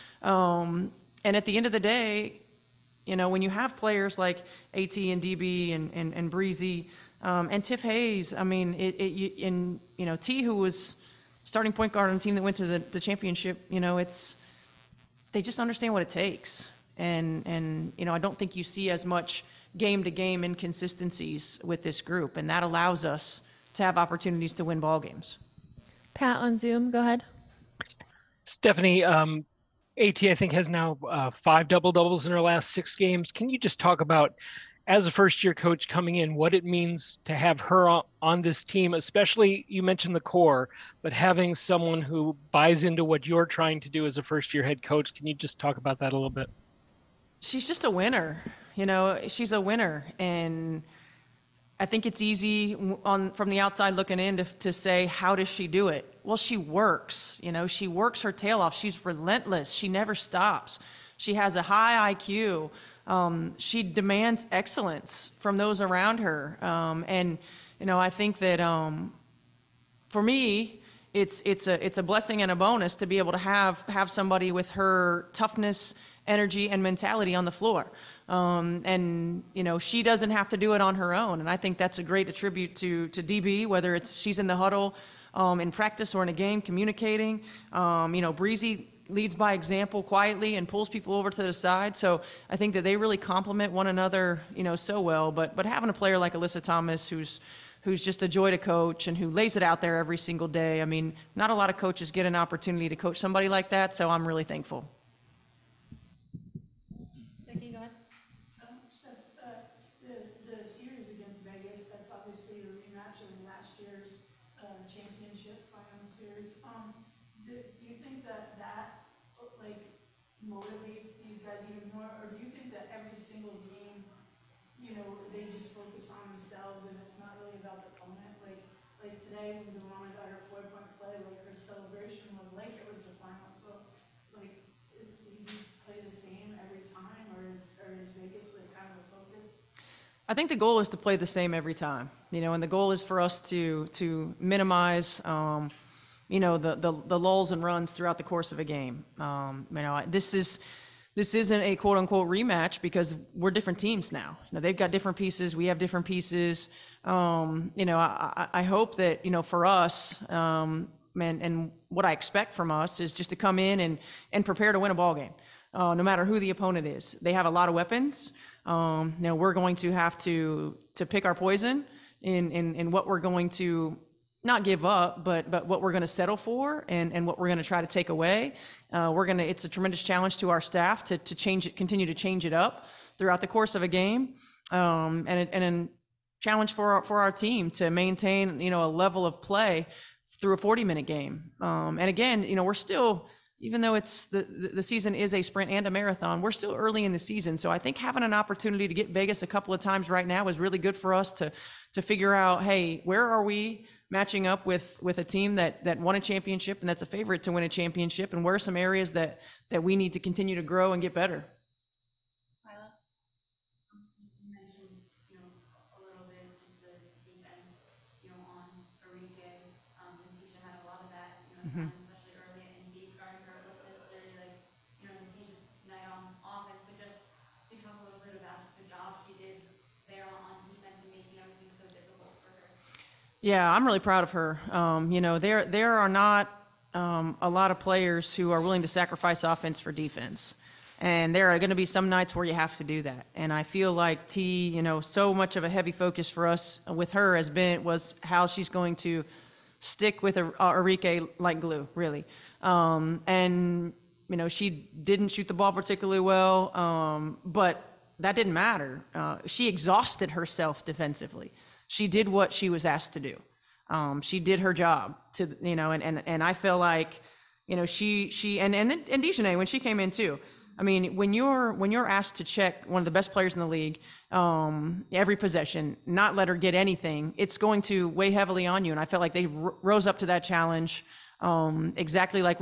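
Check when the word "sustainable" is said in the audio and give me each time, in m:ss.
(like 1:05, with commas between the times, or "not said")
not said.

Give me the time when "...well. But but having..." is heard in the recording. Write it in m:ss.
1:34.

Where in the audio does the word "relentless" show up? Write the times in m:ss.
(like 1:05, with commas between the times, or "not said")
0:59.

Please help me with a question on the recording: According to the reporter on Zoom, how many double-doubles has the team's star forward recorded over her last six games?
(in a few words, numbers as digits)
5.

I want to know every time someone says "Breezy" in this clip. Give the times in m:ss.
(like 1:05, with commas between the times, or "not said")
0:06, 1:28.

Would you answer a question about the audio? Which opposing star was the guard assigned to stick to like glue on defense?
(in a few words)
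Arike.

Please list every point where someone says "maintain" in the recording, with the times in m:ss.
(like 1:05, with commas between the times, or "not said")
3:07.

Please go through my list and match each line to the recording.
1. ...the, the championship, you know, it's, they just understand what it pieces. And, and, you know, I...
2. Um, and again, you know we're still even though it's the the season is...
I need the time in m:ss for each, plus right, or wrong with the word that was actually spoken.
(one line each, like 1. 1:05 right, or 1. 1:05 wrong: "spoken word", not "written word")
1. 0:12 wrong: "takes", not "pieces"
2. 3:11 right.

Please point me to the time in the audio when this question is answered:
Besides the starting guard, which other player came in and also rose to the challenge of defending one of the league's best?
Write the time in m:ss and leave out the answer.
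4:29.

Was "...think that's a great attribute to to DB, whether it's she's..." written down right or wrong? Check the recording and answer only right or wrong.
right.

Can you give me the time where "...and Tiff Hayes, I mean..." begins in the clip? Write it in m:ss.
0:07.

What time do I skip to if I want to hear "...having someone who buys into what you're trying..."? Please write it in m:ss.
0:41.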